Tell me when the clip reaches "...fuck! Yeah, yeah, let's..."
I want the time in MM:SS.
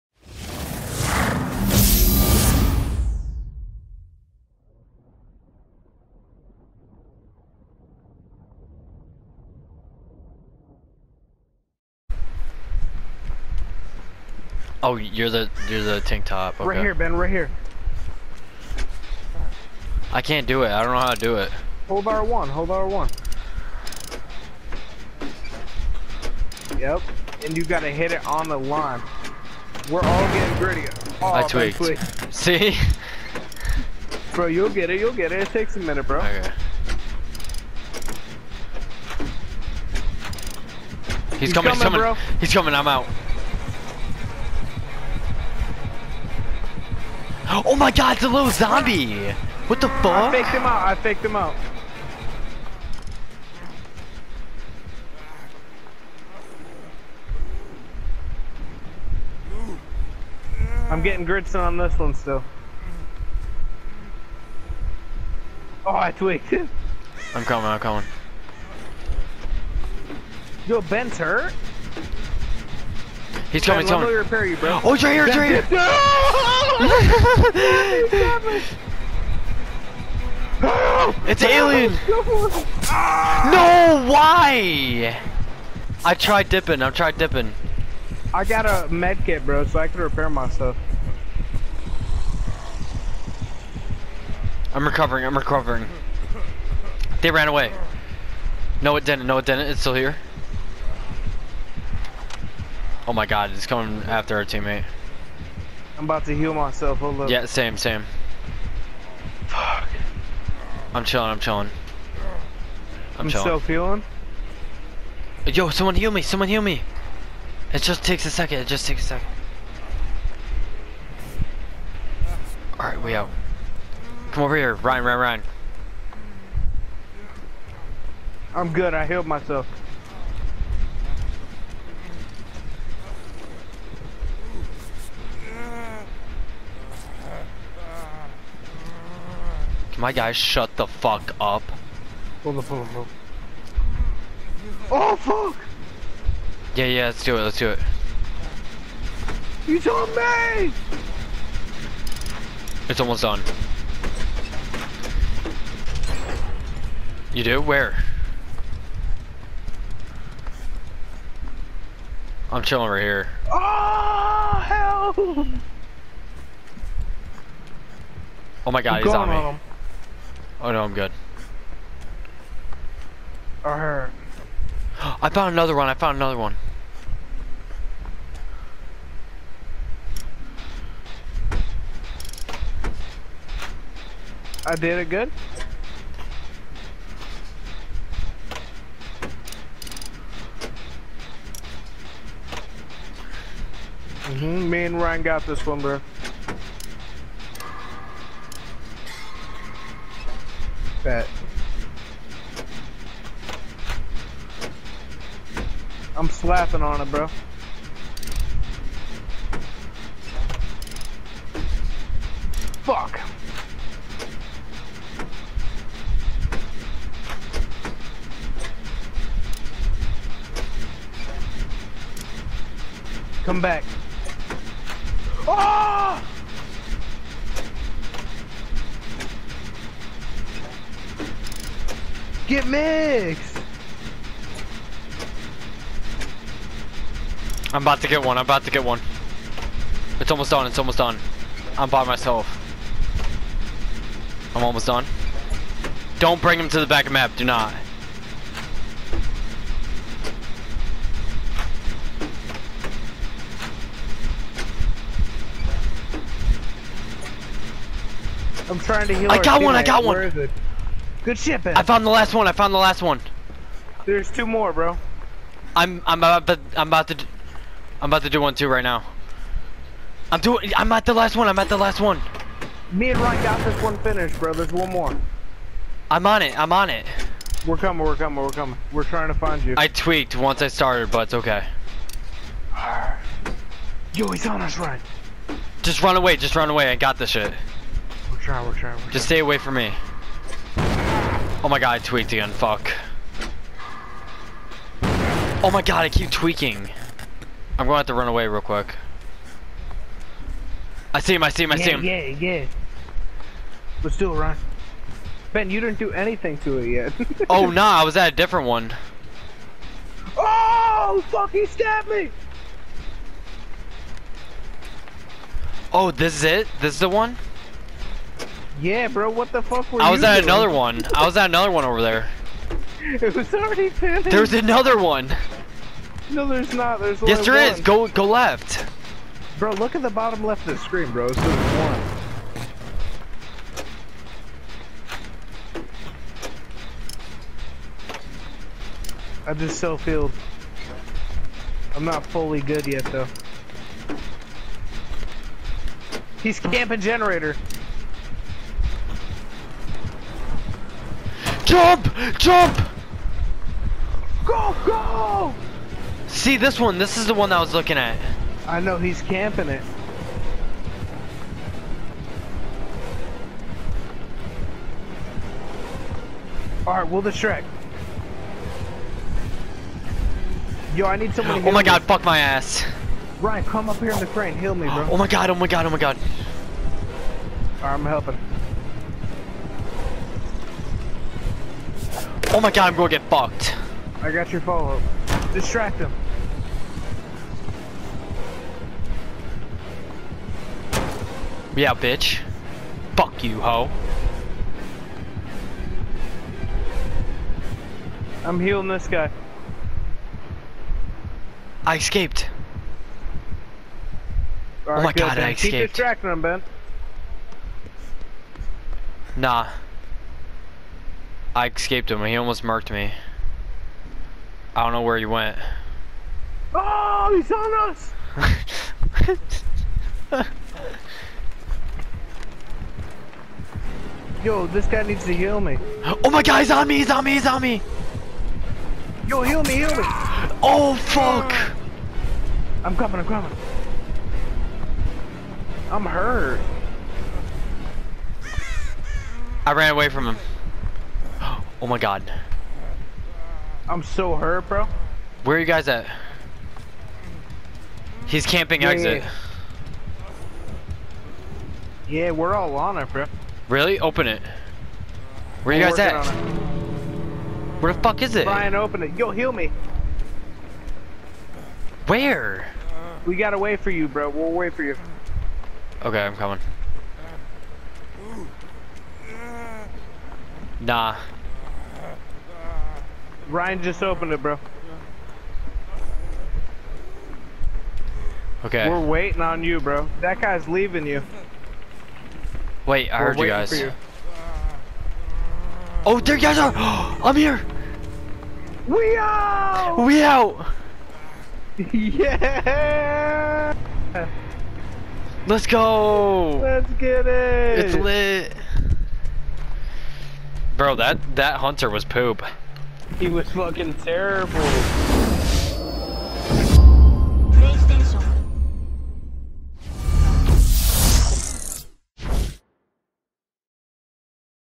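02:25.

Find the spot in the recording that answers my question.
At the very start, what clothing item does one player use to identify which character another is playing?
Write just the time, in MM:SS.
00:16.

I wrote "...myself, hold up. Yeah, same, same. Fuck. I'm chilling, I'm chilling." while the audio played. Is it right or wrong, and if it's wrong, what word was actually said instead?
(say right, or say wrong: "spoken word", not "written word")
right.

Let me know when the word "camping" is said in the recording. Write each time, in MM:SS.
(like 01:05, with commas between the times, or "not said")
05:46, 05:59, 07:28.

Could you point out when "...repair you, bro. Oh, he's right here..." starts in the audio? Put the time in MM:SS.
01:14.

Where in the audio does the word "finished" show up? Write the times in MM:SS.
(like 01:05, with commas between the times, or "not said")
04:33, 05:23.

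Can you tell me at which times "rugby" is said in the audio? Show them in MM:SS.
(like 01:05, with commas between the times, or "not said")
not said.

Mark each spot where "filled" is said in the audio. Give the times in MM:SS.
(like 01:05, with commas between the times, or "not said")
05:39.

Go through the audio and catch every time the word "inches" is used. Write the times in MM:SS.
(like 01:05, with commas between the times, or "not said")
not said.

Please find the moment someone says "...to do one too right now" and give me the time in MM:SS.
04:28.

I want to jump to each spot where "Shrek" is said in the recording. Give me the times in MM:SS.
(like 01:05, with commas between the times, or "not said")
06:07.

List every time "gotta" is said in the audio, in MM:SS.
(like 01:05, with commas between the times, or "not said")
00:27, 07:43.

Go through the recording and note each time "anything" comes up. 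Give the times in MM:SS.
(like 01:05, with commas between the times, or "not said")
05:06.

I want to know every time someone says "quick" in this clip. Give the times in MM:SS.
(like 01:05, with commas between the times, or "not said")
04:58.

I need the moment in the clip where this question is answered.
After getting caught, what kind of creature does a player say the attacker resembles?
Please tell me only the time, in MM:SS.
01:21.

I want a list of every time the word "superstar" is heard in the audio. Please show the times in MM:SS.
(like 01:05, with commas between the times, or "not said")
not said.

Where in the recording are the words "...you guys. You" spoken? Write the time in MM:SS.
08:03.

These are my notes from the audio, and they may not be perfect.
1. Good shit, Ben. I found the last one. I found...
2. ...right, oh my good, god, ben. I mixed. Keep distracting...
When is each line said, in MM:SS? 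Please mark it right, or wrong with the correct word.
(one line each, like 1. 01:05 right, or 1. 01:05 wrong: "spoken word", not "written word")
1. 04:21 right
2. 06:44 wrong: "escaped", not "mixed".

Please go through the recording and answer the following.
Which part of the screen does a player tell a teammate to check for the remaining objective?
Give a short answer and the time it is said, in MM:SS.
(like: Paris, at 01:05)
Bottom left, at 05:30.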